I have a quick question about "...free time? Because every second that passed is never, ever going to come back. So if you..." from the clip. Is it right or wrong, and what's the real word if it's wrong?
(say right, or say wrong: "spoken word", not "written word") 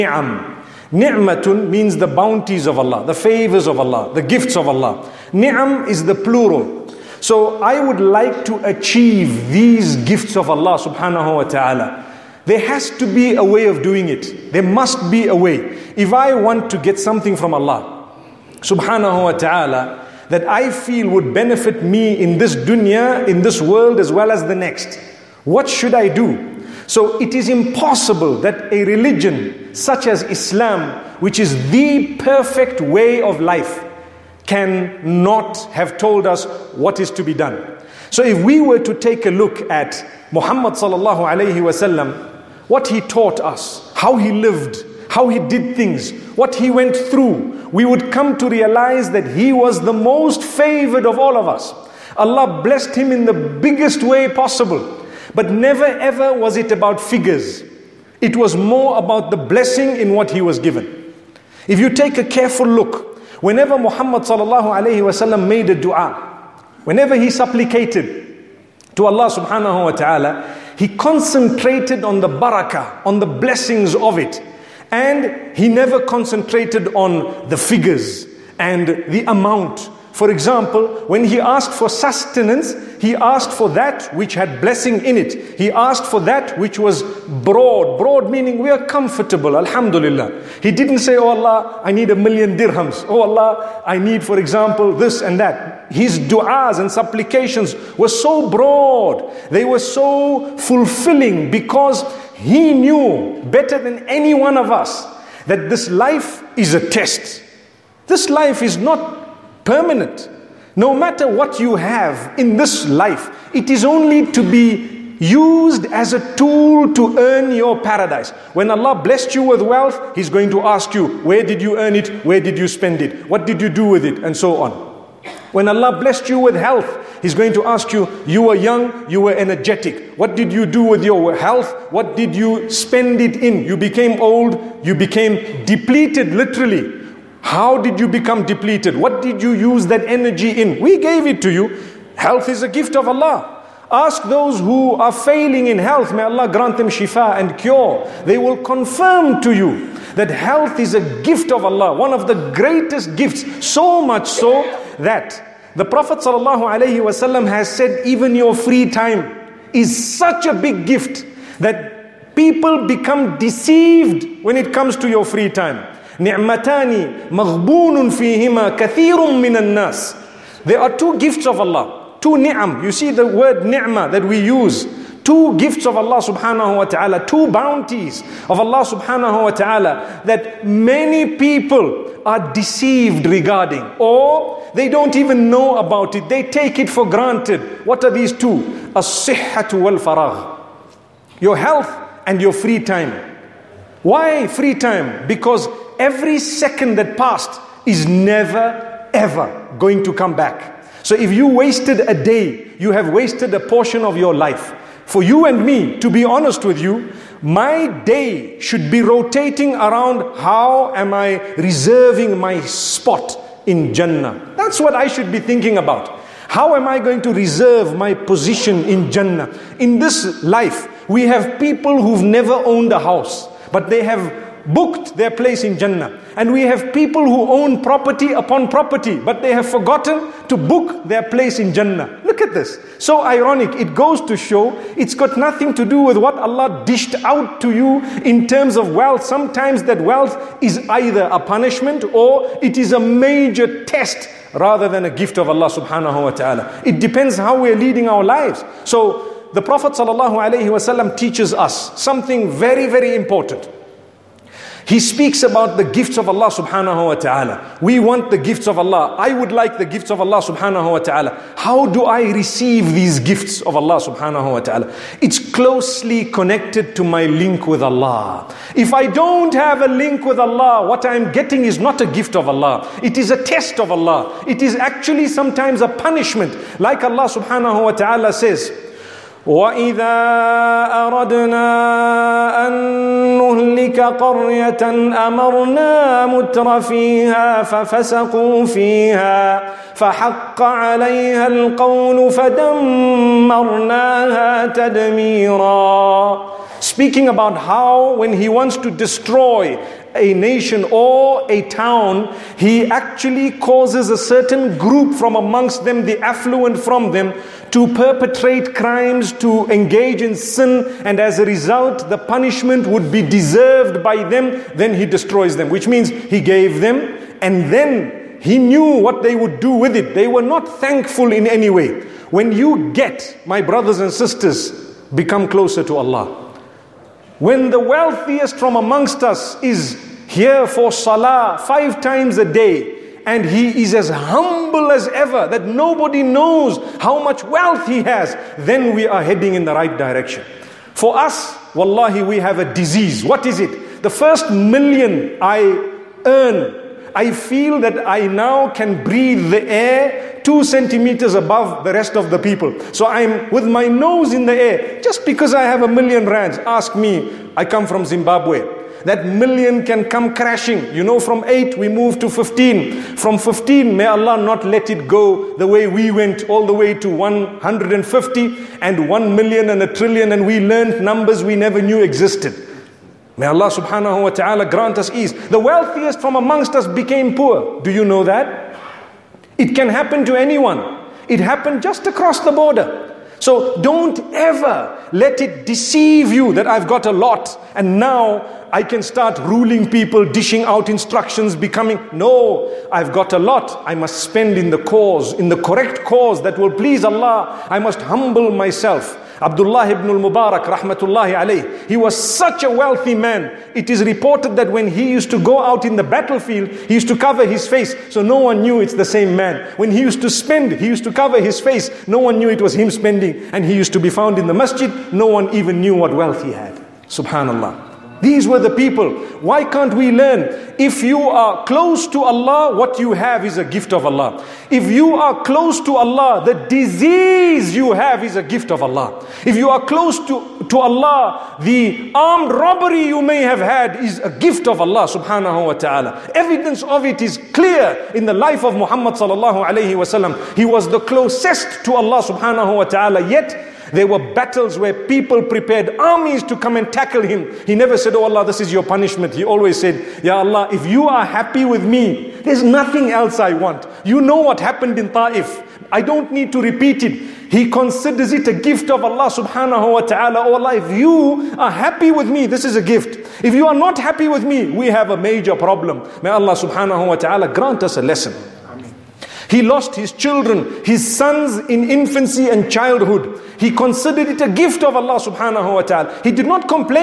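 right.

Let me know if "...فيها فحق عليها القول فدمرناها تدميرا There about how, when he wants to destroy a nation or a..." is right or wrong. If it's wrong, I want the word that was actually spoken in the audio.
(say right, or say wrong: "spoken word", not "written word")
wrong: "Speaking", not "There".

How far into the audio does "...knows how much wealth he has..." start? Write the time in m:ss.
5:36.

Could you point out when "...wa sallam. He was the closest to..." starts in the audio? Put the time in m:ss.
7:19.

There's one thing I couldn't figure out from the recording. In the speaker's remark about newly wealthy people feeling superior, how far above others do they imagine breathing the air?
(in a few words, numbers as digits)
2 centimeters.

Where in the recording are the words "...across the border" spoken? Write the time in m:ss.
6:22.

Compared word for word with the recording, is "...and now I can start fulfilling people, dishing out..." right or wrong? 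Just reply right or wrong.
wrong.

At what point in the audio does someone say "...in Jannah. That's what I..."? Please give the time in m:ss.
3:33.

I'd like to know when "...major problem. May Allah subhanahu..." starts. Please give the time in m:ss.
7:45.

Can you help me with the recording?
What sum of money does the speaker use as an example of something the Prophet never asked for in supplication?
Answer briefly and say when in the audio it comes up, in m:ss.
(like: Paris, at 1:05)
a million dirhams, at 1:32.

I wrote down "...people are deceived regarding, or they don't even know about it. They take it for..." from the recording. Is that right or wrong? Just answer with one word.
right.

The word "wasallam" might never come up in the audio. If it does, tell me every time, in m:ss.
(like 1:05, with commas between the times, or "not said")
0:41, 1:04.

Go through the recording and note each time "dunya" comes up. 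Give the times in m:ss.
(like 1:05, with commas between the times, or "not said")
0:22.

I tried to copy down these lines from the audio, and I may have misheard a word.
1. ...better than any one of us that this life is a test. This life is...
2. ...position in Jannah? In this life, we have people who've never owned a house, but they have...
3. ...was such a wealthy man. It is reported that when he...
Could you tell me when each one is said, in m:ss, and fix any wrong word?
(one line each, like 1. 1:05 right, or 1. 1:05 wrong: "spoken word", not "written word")
1. 1:43 right
2. 3:38 right
3. 6:41 right.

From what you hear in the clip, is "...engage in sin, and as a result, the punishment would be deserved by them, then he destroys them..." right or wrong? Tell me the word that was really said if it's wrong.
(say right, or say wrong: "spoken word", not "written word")
right.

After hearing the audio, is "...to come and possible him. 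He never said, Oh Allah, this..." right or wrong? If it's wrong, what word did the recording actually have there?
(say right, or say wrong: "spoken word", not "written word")
wrong: "tackle", not "possible".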